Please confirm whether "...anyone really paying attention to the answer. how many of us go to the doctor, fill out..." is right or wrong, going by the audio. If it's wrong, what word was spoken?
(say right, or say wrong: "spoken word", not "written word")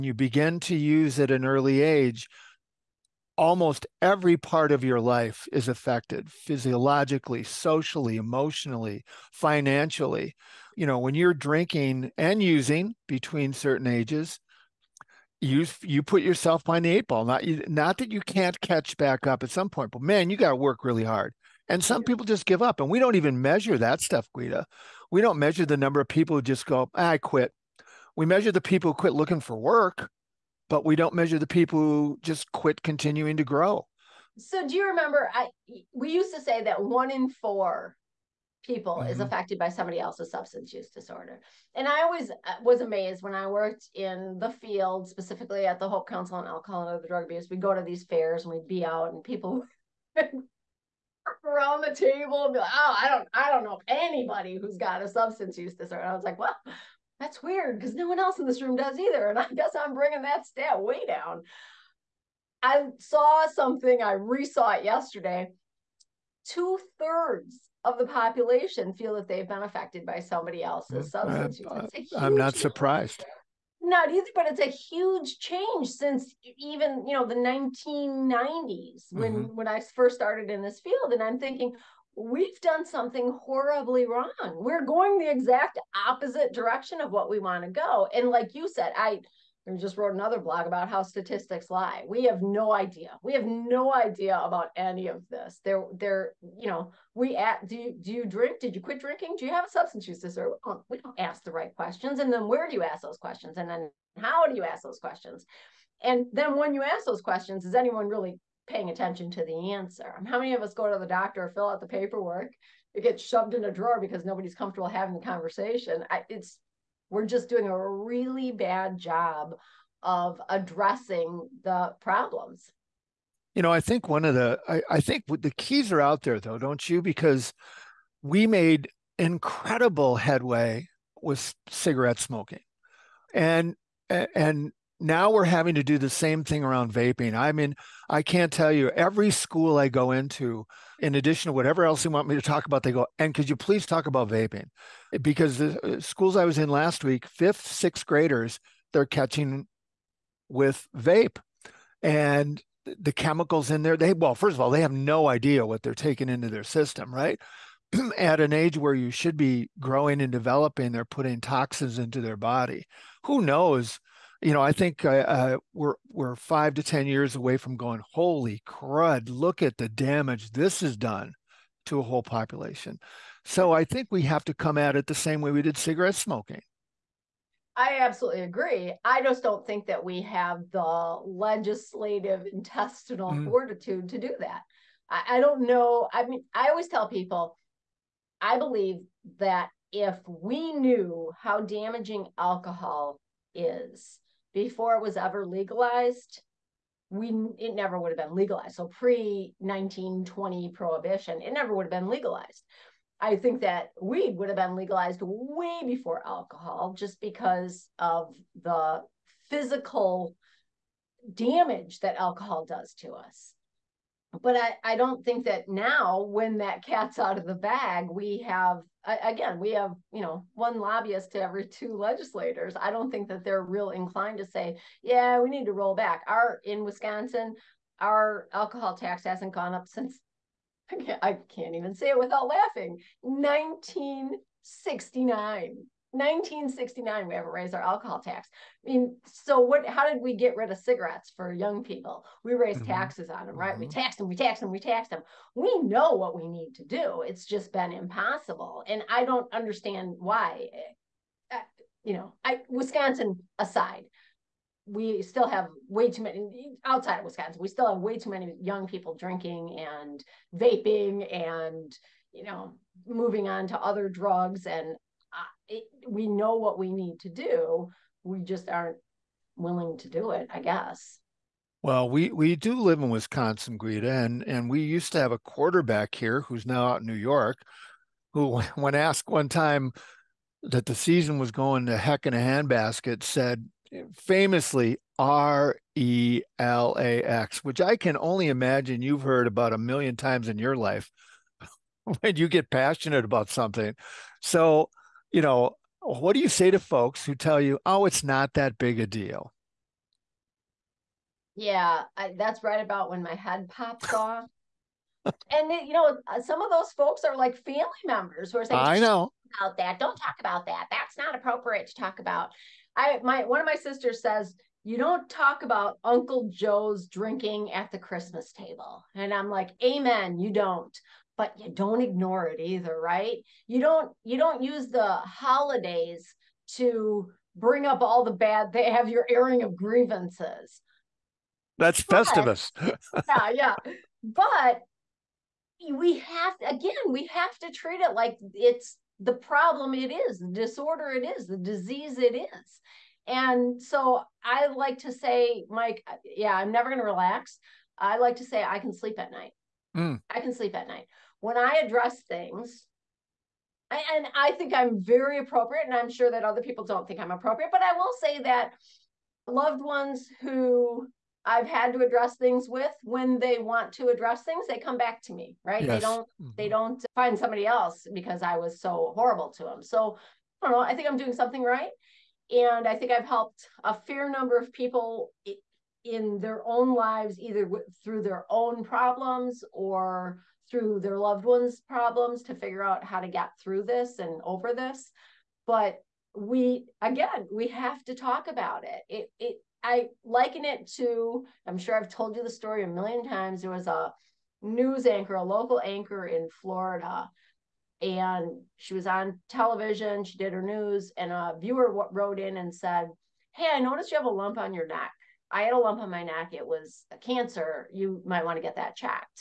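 right.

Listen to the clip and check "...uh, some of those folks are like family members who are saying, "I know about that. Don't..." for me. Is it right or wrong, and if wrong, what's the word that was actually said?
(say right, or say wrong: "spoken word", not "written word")
right.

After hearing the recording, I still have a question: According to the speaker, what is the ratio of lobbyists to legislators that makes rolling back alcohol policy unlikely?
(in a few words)
1 to every 2.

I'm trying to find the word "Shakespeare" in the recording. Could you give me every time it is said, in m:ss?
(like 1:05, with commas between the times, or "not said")
not said.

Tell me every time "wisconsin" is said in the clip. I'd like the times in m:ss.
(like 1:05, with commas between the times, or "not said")
3:46, 4:12, 4:17, 4:33.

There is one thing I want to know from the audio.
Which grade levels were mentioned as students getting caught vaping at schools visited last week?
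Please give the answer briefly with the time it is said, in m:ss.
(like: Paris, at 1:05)
Fifth, sixth graders, at 2:27.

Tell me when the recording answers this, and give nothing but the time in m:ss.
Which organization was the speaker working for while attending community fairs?
0:45.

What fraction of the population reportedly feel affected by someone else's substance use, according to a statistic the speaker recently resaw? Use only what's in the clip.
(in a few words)
Two thirds.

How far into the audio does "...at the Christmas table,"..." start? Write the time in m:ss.
5:17.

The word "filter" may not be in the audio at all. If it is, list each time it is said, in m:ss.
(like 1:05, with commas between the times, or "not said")
not said.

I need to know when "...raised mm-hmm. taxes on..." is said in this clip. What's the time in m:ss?
4:02.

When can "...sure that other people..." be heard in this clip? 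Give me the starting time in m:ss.
5:56.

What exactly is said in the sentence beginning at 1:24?
We're going the exact opposite direction of what we want to go.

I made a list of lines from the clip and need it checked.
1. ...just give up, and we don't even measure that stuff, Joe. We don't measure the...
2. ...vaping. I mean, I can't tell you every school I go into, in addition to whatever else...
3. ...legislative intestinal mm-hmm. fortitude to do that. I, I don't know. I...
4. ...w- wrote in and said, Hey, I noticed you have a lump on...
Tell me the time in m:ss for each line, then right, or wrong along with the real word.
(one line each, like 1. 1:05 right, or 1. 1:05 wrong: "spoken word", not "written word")
1. 0:22 wrong: "Guida", not "Joe"
2. 2:16 right
3. 3:01 right
4. 6:41 right.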